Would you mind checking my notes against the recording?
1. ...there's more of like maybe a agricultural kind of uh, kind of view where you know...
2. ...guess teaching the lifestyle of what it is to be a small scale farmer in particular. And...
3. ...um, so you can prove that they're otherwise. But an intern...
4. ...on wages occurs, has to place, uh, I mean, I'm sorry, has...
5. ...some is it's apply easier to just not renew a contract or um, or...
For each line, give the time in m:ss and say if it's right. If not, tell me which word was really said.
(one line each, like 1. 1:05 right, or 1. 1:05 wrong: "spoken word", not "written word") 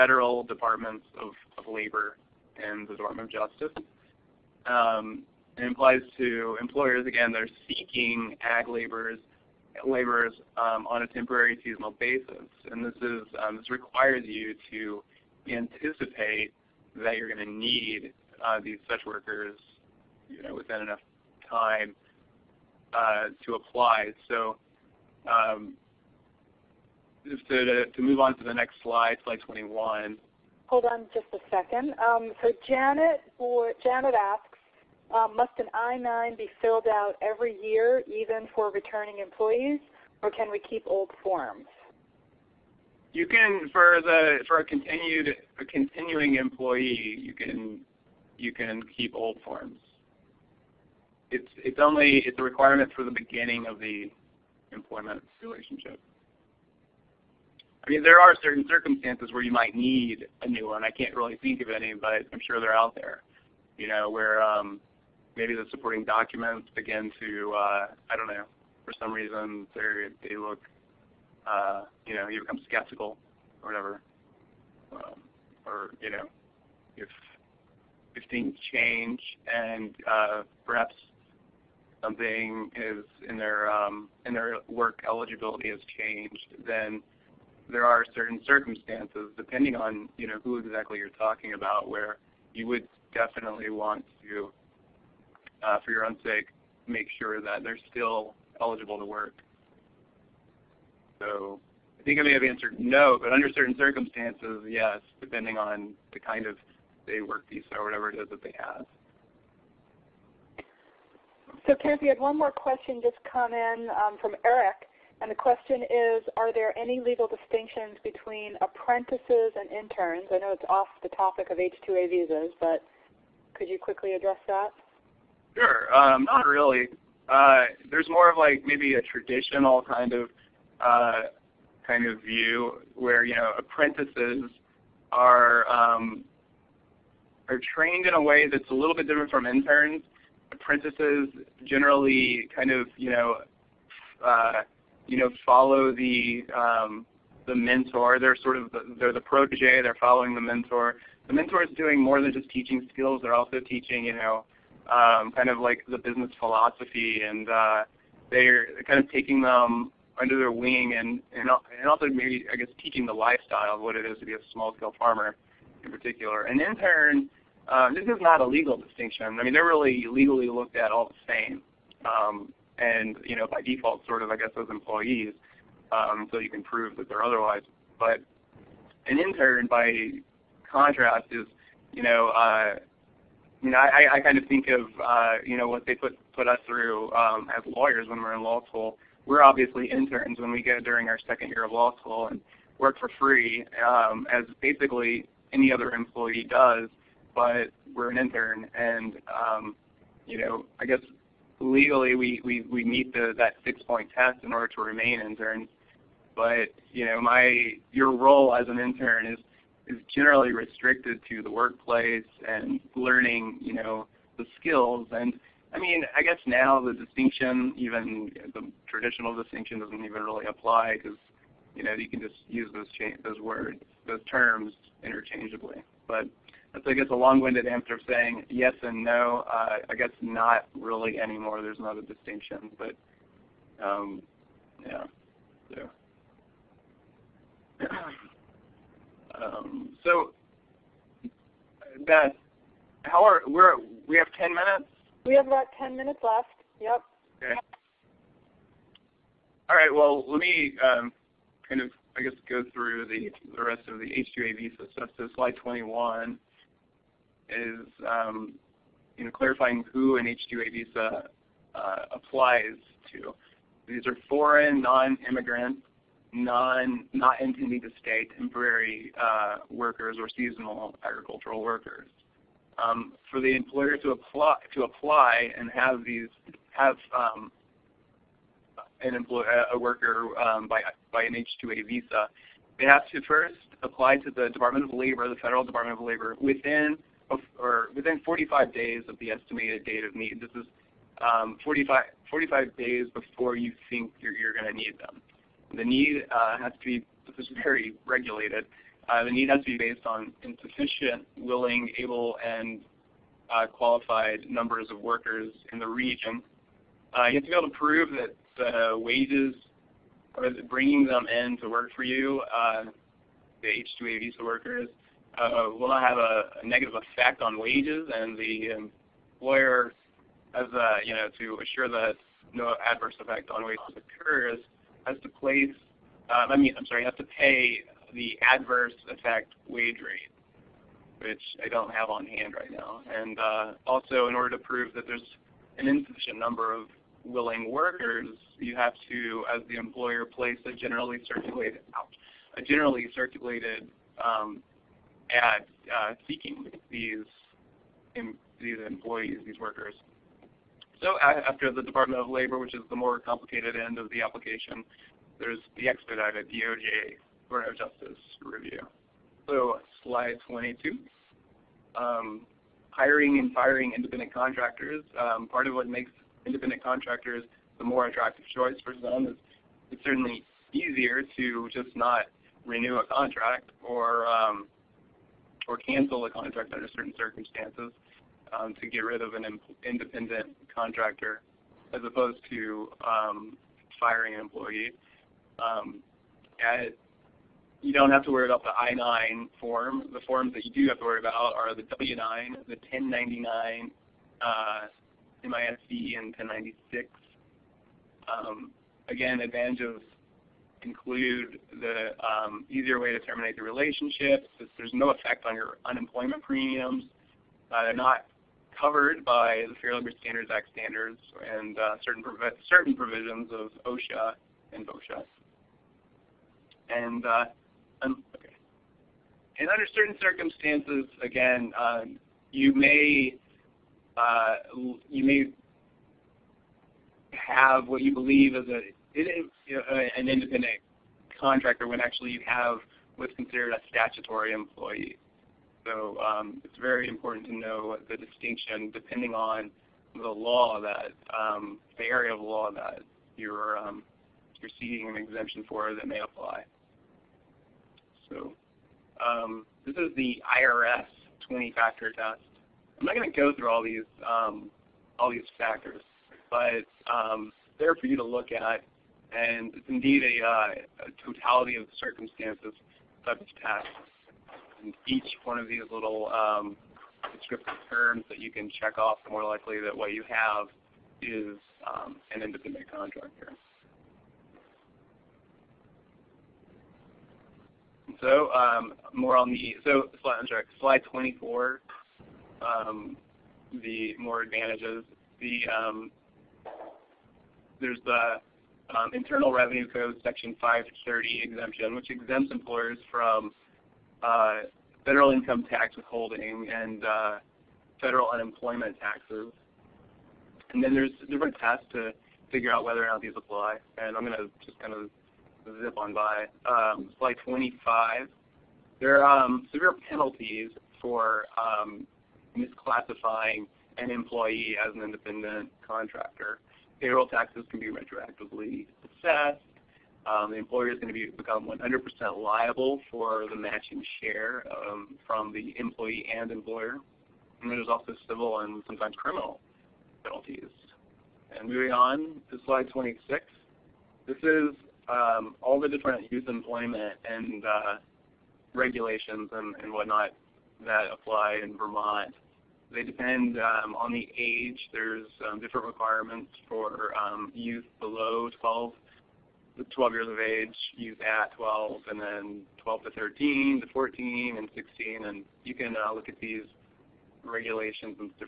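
1. 2:07 wrong: "traditional", not "agricultural"
2. 2:42 right
3. 2:55 right
4. 5:23 right
5. 6:09 wrong: "certainly", not "apply".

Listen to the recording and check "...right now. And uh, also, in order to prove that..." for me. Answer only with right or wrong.
right.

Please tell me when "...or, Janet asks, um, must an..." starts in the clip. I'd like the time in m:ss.
0:33.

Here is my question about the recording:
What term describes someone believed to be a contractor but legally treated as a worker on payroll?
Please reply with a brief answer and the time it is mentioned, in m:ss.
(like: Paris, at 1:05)
statutory employee, at 7:13.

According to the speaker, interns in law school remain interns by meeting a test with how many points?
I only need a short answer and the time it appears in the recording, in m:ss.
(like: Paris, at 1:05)
6, at 3:23.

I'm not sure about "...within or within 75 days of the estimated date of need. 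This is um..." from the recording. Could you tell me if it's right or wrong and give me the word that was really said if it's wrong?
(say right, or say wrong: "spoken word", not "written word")
wrong: "45", not "75".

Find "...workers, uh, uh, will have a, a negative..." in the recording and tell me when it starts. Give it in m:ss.
5:14.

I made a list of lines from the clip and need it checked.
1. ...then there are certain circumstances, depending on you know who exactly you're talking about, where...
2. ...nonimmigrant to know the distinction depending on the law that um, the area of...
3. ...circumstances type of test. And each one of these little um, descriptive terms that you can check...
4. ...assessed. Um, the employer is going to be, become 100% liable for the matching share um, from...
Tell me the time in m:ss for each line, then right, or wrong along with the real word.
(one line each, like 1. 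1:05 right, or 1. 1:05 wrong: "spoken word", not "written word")
1. 1:26 right
2. 7:17 wrong: "important", not "nonimmigrant"
3. 7:41 right
4. 8:39 right.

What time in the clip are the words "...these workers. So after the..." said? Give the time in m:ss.
5:49.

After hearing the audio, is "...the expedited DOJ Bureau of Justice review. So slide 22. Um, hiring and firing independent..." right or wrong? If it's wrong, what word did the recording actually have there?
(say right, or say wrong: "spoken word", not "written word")
right.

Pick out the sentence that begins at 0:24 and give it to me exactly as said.
So um, just to, to, move on to the next slide, slide 21.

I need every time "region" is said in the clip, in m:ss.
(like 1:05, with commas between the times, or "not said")
5:05.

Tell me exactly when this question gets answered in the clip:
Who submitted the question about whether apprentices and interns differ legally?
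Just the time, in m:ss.
1:54.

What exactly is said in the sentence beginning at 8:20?
And then there's different tests to figure out whether or not these apply.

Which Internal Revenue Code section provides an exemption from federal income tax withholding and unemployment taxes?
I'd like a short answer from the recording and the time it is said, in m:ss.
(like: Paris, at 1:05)
Section 530, at 8:10.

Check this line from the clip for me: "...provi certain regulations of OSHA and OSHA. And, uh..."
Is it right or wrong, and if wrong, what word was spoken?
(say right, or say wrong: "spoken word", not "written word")
wrong: "provisions", not "regulations".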